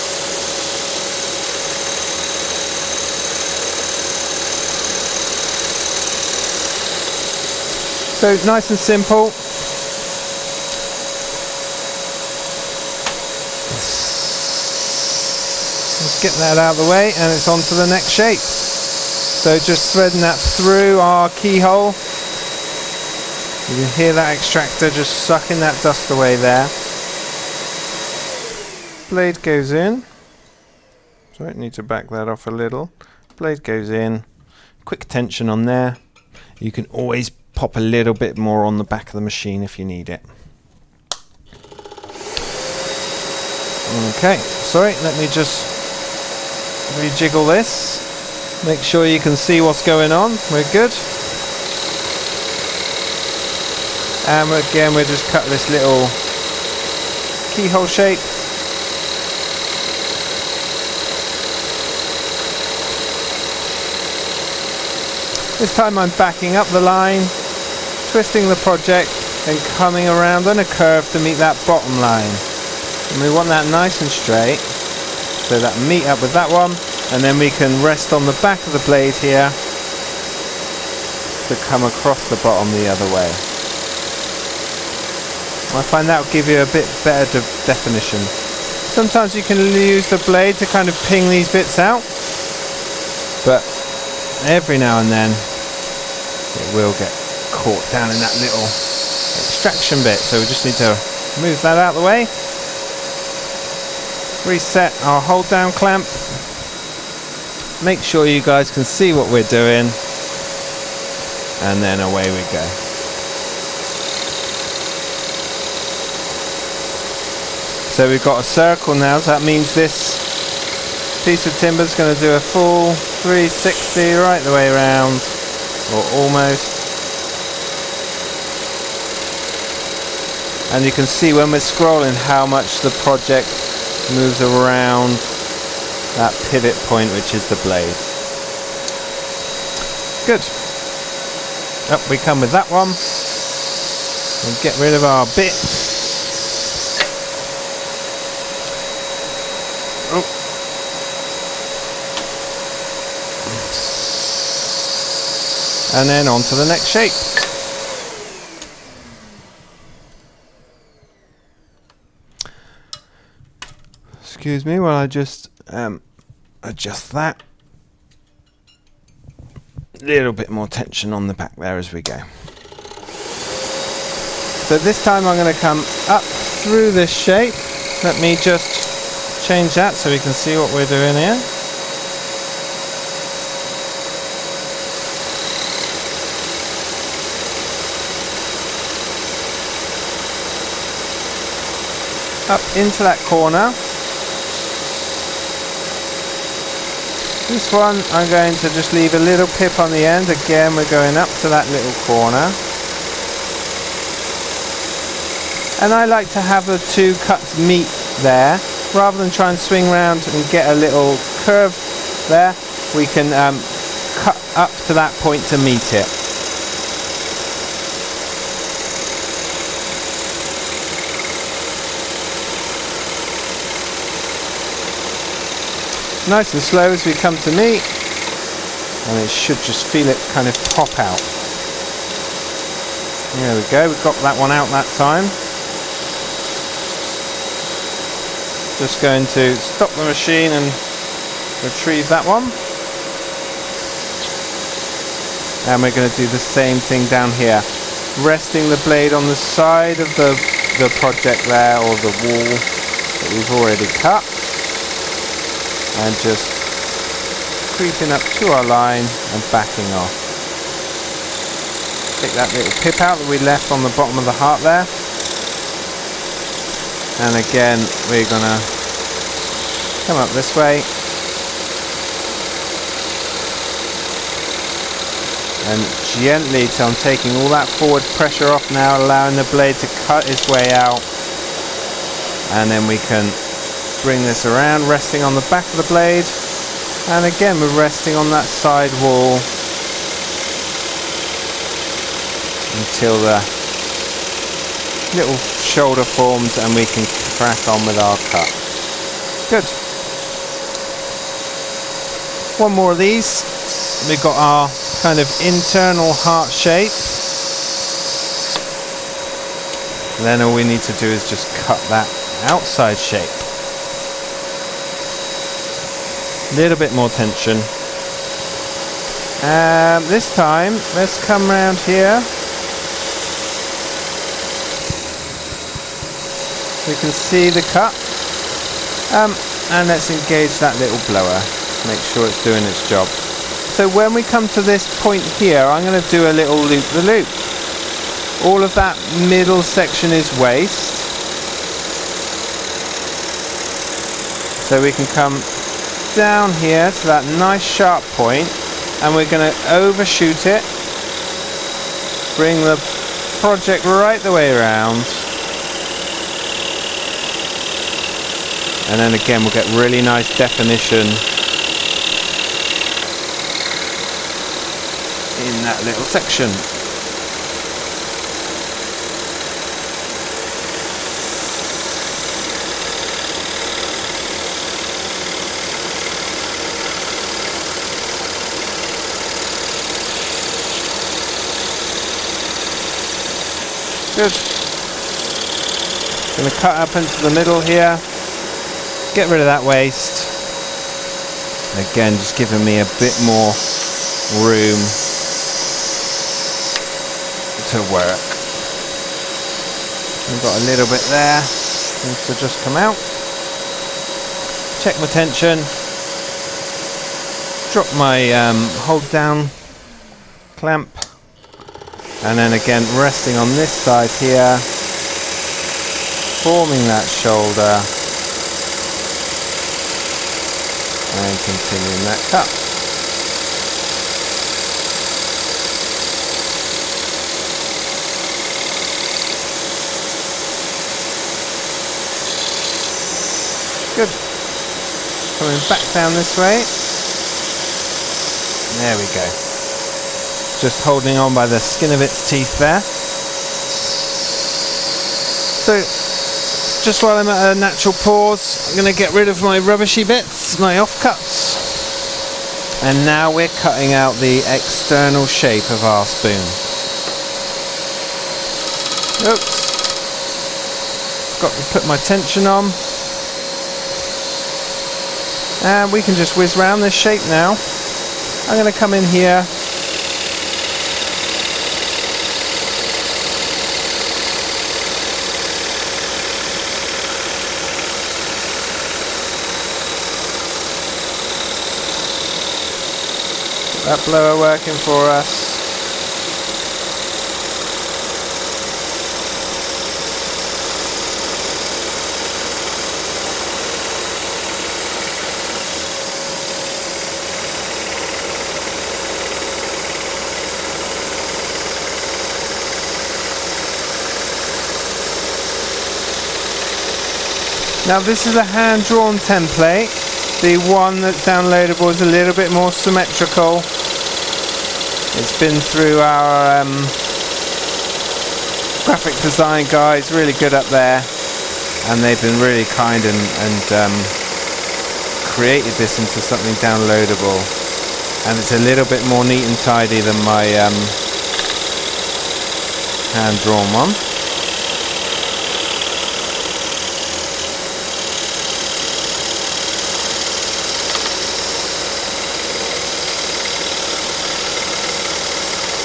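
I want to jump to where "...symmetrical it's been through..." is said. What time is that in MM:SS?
08:32.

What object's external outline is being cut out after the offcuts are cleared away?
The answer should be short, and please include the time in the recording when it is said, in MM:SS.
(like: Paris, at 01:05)
Spoon, at 07:36.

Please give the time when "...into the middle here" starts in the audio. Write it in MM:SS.
06:26.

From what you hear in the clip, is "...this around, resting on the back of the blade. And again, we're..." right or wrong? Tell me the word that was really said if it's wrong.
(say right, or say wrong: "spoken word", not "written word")
right.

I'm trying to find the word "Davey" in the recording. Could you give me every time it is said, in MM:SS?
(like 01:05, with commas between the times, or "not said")
not said.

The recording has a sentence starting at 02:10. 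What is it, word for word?
and you can see when we're scrolling how much the project moves around that pivot point which is the blade.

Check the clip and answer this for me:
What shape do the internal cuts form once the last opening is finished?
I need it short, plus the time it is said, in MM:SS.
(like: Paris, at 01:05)
Heart shape, at 05:06.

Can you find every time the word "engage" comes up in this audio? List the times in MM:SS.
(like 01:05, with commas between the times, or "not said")
05:30.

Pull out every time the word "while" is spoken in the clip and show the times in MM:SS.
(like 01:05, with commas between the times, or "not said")
02:44, 07:27.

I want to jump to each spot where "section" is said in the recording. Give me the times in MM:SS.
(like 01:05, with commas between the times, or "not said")
05:39, 06:06.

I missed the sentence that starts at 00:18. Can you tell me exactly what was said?
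So just threading that through our keyhole.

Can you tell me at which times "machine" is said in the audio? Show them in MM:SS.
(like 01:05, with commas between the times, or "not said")
00:39, 04:00.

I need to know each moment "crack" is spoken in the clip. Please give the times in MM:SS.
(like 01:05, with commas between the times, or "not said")
04:57.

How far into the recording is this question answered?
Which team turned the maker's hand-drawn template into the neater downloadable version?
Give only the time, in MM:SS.
08:38.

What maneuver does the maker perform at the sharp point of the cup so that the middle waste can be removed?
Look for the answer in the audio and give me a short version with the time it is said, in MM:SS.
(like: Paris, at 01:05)
Loop-the-loop, at 05:36.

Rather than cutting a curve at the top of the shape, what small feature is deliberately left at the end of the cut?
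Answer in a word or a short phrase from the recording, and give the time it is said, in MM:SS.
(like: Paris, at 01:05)
A little pip, at 03:19.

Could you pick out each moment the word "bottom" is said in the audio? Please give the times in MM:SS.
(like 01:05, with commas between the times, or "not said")
01:11, 01:22, 04:23.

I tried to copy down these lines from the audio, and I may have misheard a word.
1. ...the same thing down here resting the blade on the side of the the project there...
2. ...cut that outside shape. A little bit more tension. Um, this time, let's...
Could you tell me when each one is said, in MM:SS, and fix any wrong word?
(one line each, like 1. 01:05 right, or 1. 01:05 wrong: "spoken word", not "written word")
1. 04:06 right
2. 05:11 right.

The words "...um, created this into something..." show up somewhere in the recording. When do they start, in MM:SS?
08:43.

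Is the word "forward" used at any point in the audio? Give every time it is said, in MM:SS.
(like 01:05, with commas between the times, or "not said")
04:37.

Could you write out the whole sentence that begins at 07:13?
good coming back down this way there we go just holding on by the skin of its teeth there.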